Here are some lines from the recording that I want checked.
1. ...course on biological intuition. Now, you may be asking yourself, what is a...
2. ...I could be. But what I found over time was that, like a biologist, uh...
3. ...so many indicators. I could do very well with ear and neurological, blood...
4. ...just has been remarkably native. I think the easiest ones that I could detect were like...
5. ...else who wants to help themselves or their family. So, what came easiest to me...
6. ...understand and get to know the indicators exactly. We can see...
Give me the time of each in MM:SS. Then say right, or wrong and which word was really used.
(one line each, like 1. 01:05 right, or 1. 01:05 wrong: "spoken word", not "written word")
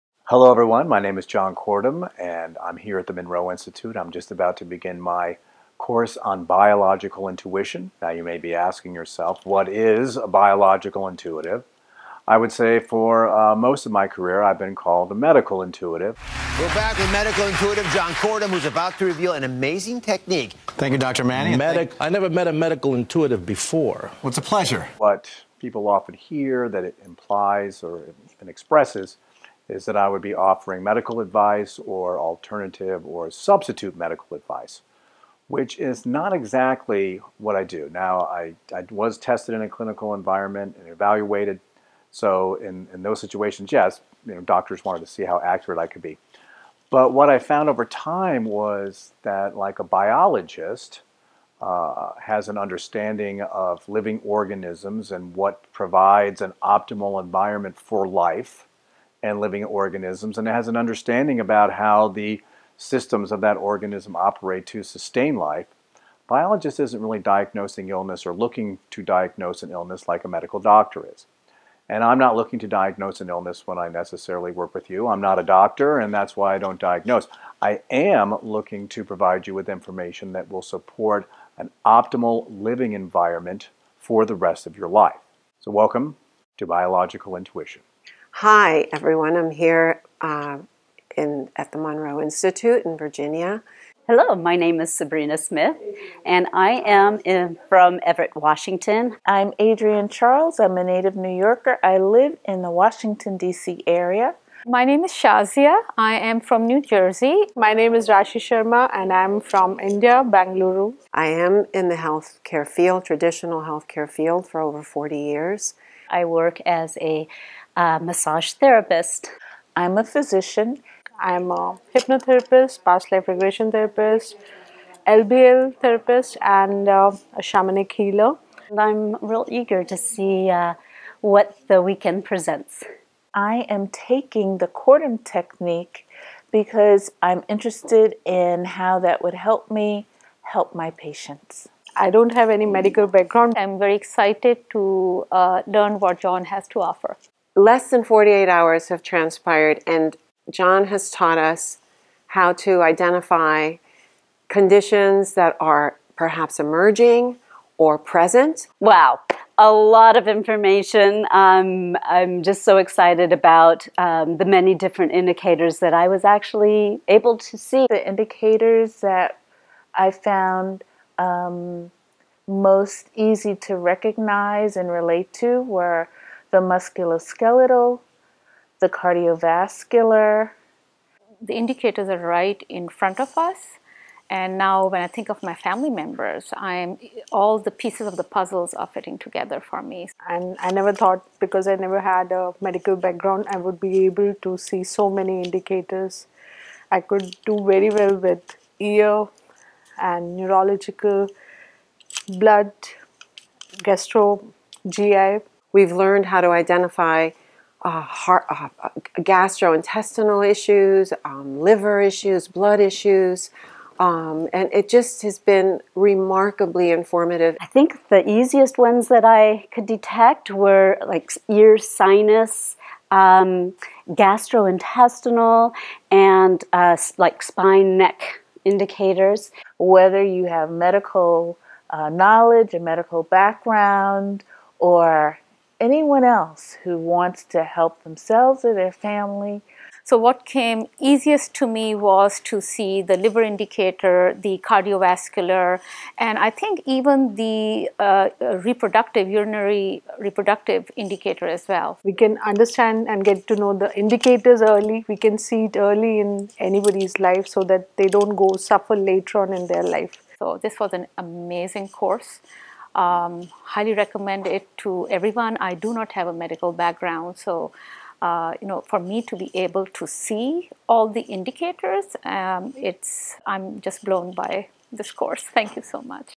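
1. 00:05 right
2. 00:45 right
3. 03:14 right
4. 03:34 wrong: "informative", not "native"
5. 03:56 right
6. 04:12 wrong: "early", not "exactly".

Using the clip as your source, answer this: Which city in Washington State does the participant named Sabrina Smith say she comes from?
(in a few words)
Everett.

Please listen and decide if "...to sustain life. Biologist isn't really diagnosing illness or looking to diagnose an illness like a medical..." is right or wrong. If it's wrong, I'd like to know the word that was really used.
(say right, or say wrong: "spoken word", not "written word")
right.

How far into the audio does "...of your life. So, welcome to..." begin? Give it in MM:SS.
01:24.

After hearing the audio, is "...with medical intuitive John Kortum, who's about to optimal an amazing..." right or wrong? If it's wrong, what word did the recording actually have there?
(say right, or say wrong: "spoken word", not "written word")
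wrong: "reveal", not "optimal".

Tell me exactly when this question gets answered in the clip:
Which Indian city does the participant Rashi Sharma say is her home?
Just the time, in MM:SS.
01:50.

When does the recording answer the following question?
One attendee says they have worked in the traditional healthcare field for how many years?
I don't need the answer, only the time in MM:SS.
01:54.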